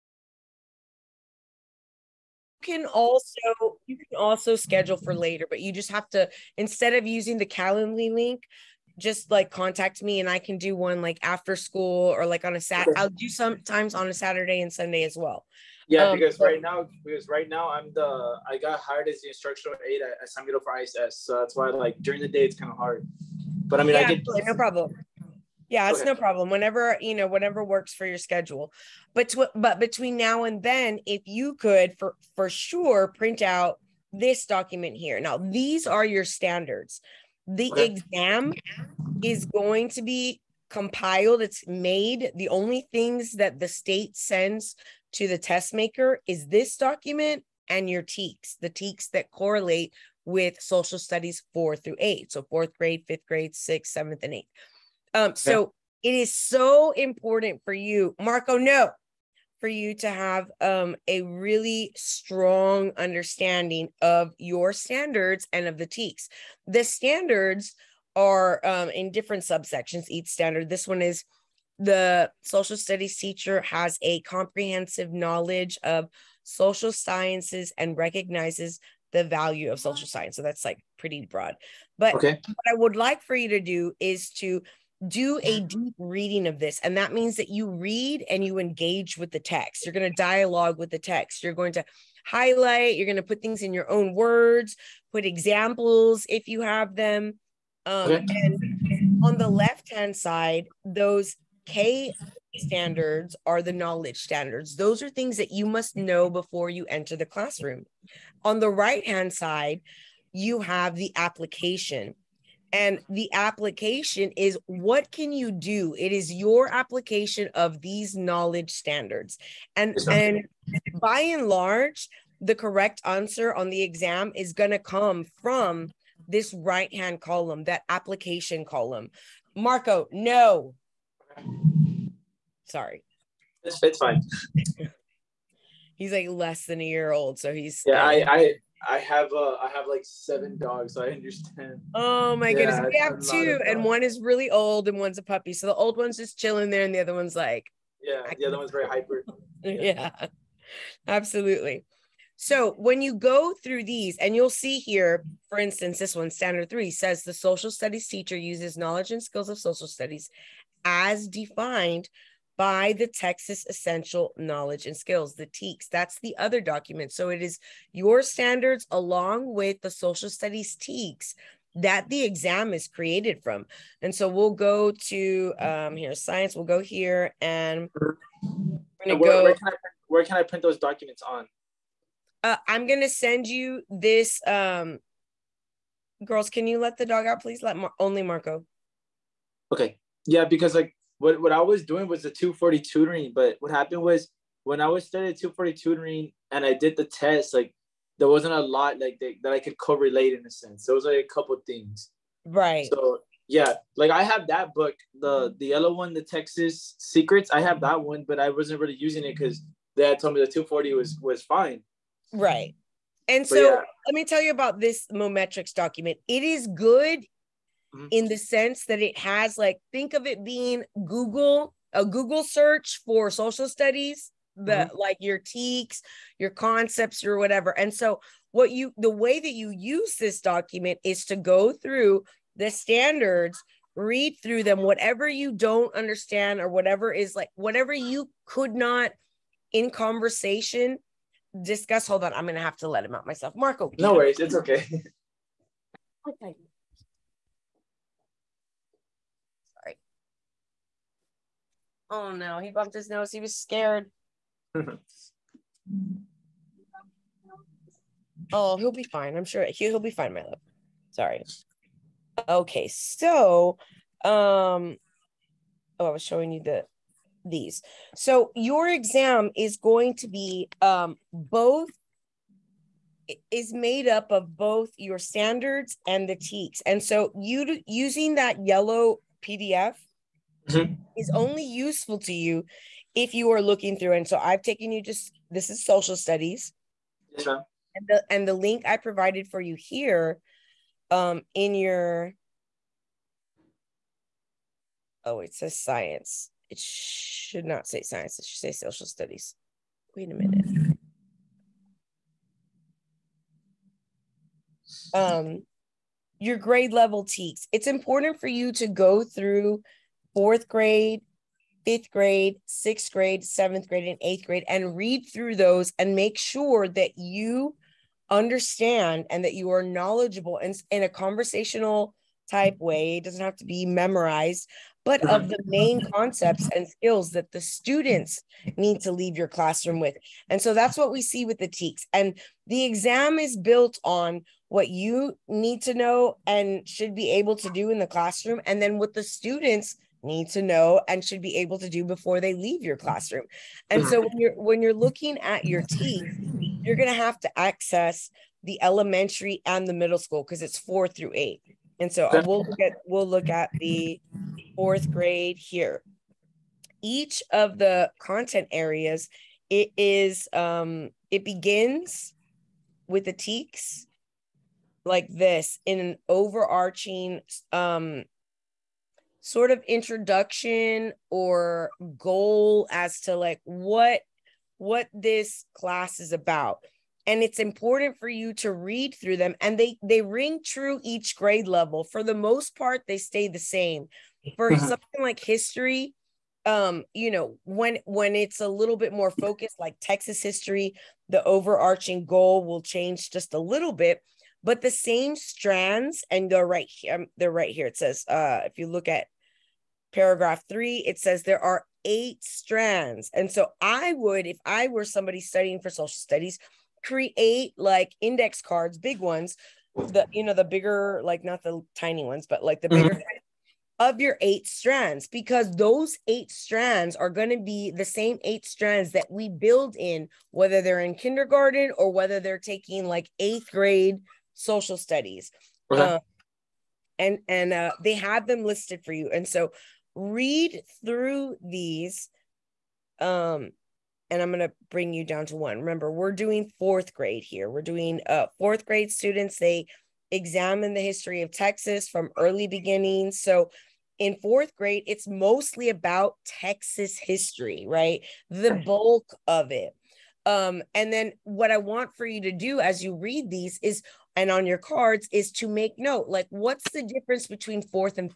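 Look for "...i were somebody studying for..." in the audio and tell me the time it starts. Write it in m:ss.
6:44.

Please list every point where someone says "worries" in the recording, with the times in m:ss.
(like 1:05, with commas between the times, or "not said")
4:04.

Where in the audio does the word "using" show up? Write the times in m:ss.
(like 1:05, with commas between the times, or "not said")
0:07, 3:28, 4:37.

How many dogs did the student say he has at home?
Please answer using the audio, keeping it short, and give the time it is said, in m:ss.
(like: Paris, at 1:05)
7, at 2:20.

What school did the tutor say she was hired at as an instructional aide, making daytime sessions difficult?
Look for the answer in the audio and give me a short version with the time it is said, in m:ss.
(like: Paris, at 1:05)
San Miguel, at 0:20.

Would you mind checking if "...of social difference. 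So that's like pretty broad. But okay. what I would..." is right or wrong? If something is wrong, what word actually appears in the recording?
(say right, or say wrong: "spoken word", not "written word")
wrong: "science", not "difference".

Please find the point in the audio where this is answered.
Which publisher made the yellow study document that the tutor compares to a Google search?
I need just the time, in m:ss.
3:35.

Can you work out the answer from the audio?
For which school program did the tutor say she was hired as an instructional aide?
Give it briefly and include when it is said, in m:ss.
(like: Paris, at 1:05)
ISS, at 0:20.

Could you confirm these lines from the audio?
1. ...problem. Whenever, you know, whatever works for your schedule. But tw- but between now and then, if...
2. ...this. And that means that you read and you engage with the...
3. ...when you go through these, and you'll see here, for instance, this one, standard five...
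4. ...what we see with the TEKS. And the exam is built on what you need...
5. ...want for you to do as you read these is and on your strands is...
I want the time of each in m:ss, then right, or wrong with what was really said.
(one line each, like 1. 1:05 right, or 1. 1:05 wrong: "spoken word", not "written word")
1. 0:26 right
2. 1:26 right
3. 2:32 wrong: "three", not "five"
4. 5:30 right
5. 7:31 wrong: "cards", not "strands".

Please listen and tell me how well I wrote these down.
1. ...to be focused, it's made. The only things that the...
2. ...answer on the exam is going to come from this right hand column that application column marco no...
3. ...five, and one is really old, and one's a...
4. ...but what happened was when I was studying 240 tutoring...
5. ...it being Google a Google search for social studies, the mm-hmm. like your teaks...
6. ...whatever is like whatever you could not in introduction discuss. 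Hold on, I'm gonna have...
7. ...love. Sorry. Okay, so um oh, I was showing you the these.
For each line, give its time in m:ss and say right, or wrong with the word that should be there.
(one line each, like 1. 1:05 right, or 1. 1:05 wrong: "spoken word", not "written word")
1. 0:39 wrong: "compiled", not "focused"
2. 2:03 right
3. 2:23 wrong: "two", not "five"
4. 3:13 right
5. 3:40 right
6. 3:56 wrong: "conversation", not "introduction"
7. 4:20 right.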